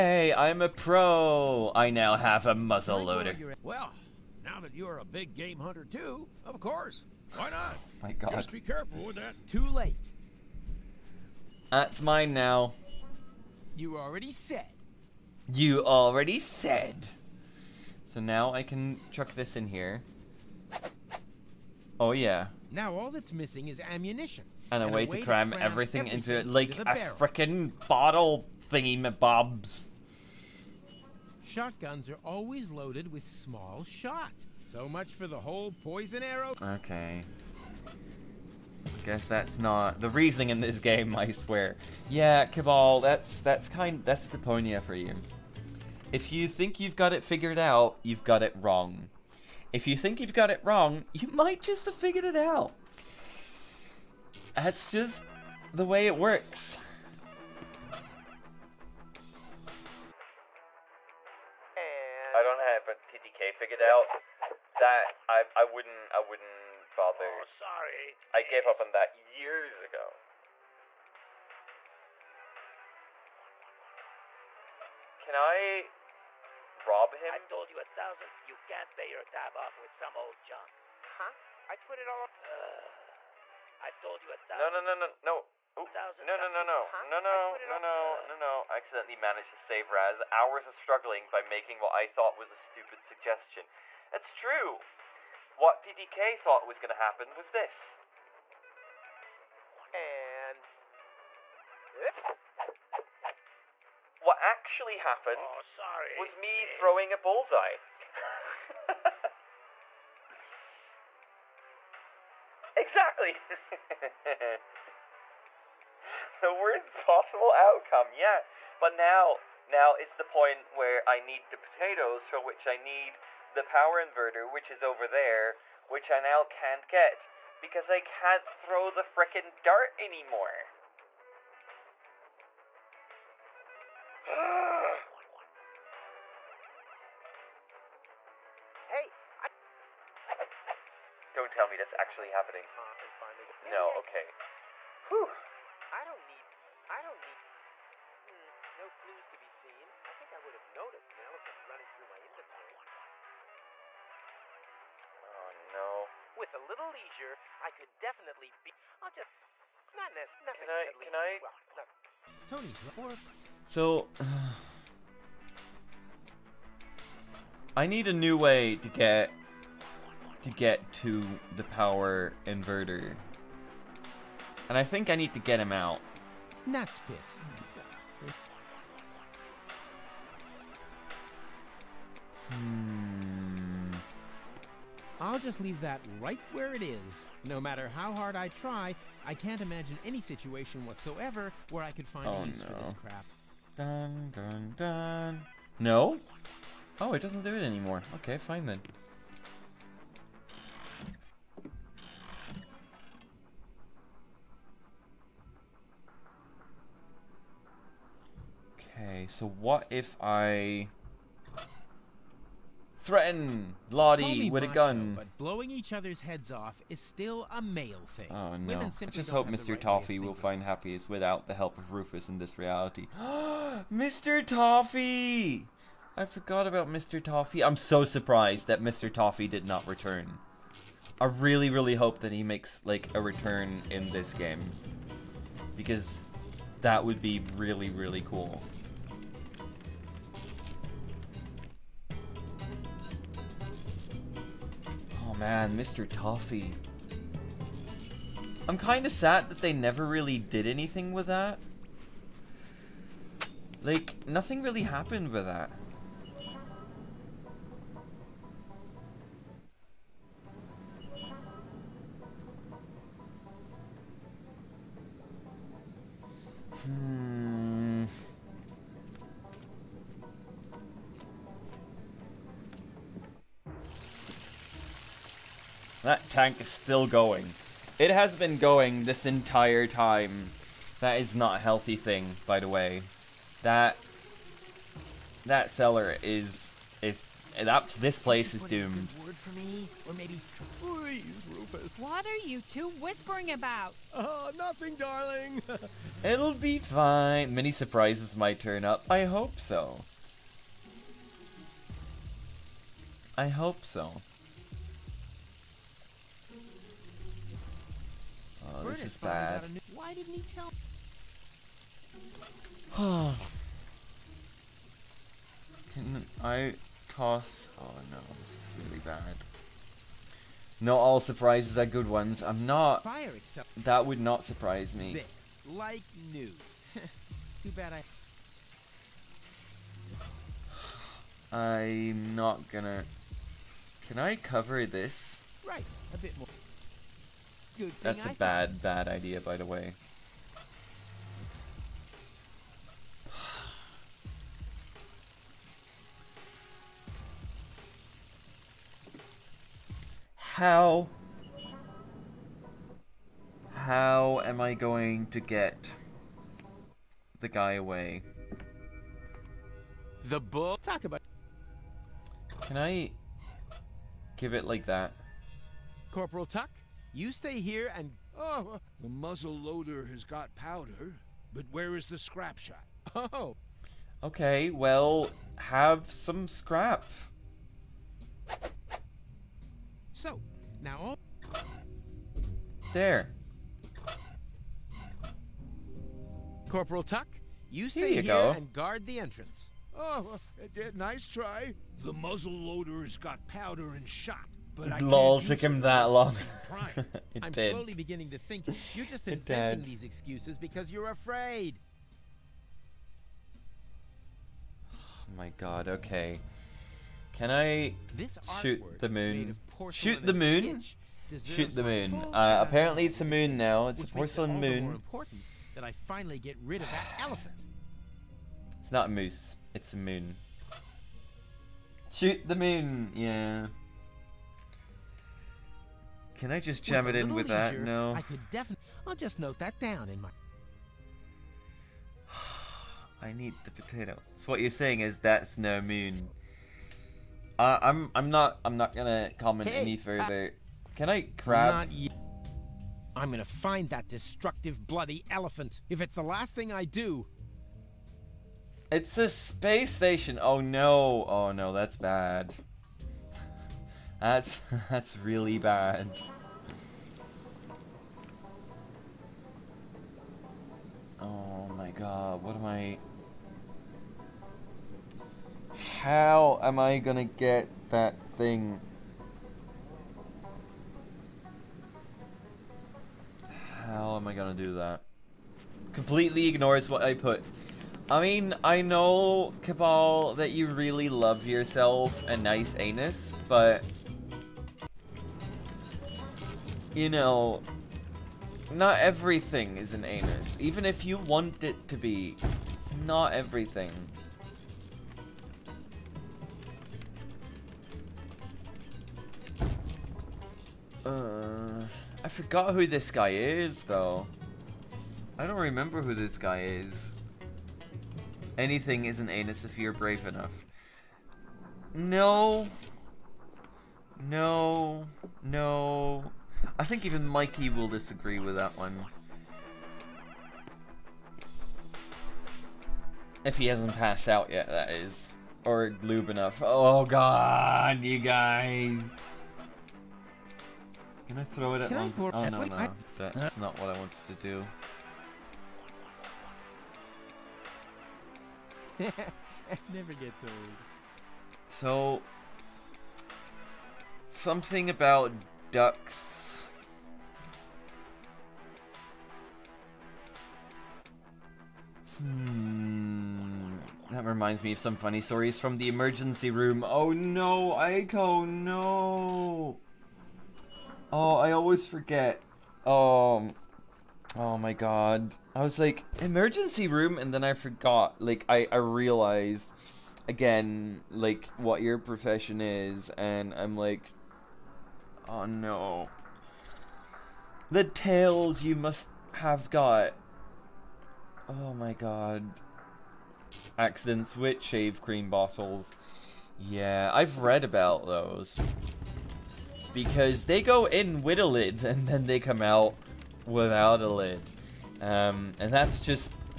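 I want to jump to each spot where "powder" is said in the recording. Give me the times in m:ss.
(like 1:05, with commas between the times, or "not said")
6:10, 6:33.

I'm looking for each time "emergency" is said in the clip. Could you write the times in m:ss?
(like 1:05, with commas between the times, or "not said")
9:15, 9:26.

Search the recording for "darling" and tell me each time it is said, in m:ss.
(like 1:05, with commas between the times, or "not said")
4:54.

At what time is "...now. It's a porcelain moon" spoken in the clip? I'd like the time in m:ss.
6:53.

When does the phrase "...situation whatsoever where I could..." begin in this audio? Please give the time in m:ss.
3:10.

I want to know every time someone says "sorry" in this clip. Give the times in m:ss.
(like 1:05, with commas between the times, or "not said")
1:07, 1:45.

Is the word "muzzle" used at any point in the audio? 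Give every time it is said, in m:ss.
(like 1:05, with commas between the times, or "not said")
0:02, 6:09, 6:32.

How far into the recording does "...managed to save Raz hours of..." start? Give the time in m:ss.
1:29.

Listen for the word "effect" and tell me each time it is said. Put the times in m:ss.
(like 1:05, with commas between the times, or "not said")
not said.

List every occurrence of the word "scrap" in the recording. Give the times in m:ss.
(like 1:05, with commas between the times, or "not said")
6:12, 6:16.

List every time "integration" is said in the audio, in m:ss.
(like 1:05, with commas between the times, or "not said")
not said.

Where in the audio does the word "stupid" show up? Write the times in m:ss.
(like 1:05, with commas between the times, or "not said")
1:32.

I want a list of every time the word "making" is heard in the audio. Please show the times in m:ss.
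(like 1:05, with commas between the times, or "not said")
1:31.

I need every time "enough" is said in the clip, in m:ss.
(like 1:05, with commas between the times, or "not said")
8:30, 8:46.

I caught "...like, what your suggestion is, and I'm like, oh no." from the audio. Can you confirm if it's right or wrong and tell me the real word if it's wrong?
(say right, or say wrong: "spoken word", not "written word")
wrong: "profession", not "suggestion".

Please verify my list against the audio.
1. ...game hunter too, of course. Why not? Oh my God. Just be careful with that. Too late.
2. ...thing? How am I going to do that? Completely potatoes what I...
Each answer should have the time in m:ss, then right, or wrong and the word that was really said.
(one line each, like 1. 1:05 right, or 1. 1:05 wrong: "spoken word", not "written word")
1. 0:05 right
2. 7:48 wrong: "ignores", not "potatoes".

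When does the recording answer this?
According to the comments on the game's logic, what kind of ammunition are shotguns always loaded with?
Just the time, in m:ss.
0:33.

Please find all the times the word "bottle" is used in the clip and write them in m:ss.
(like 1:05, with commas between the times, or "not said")
0:27, 9:45.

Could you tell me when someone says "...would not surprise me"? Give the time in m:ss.
5:24.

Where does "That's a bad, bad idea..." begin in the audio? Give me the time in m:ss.
5:38.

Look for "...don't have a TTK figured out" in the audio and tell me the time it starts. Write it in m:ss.
1:02.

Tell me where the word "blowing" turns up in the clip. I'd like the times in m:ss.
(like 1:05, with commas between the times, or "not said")
3:35.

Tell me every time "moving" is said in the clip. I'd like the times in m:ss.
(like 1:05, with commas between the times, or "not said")
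not said.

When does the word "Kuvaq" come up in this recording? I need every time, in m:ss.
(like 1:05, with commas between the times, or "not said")
0:42, 7:59.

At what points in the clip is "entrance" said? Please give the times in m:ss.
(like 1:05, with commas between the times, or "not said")
6:29.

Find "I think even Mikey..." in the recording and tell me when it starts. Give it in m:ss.
8:36.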